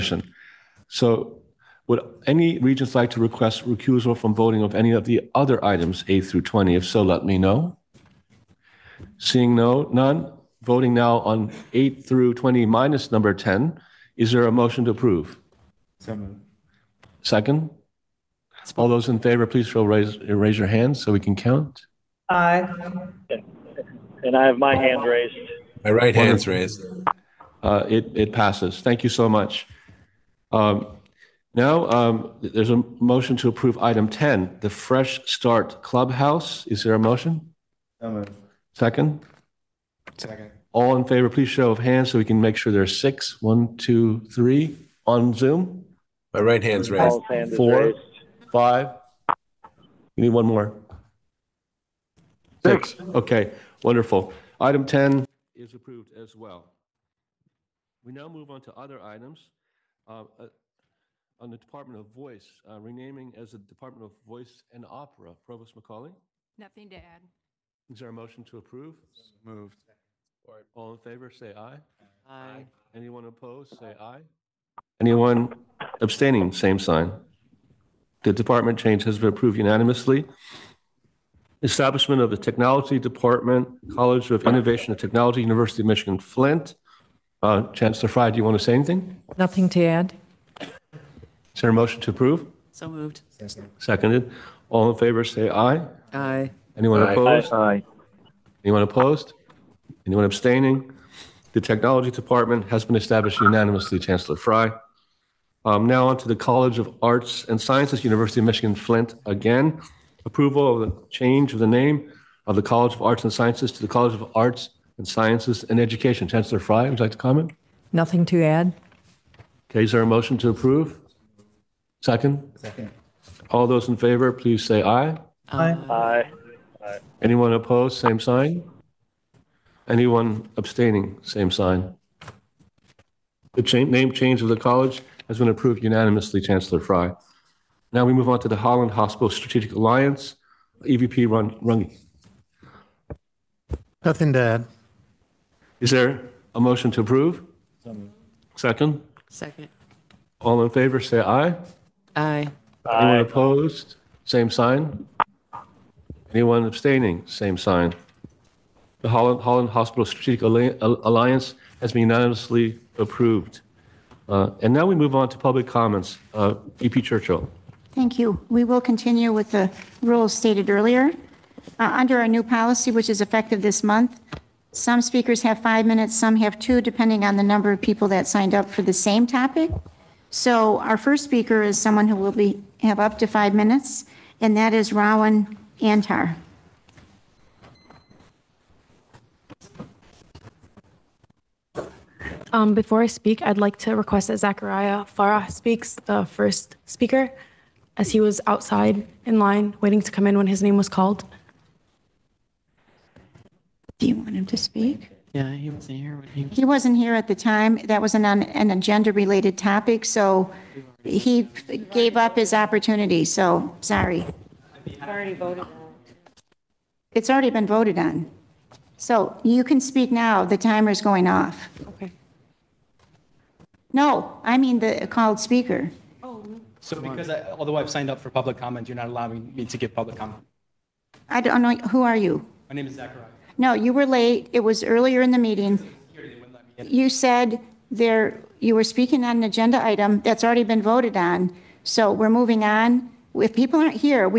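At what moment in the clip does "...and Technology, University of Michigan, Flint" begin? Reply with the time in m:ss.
1:24.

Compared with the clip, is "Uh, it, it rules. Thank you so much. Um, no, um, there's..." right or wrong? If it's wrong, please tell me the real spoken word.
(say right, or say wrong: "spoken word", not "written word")
wrong: "passes", not "rules".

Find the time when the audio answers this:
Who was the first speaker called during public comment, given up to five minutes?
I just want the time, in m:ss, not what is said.
3:04.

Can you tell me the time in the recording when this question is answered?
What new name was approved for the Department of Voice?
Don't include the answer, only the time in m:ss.
1:03.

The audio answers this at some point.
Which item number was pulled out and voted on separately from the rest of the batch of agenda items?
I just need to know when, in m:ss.
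0:12.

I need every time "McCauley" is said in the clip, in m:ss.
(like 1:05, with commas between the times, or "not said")
1:05.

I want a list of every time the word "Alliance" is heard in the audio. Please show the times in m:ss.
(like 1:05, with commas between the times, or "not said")
2:19, 2:40.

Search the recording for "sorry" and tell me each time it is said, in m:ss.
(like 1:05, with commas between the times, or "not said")
3:33.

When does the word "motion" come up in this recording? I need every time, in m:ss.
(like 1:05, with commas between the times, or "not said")
0:14, 0:32, 0:36, 1:08, 1:31, 2:00, 2:26.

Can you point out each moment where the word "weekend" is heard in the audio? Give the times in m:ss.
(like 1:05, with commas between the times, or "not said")
not said.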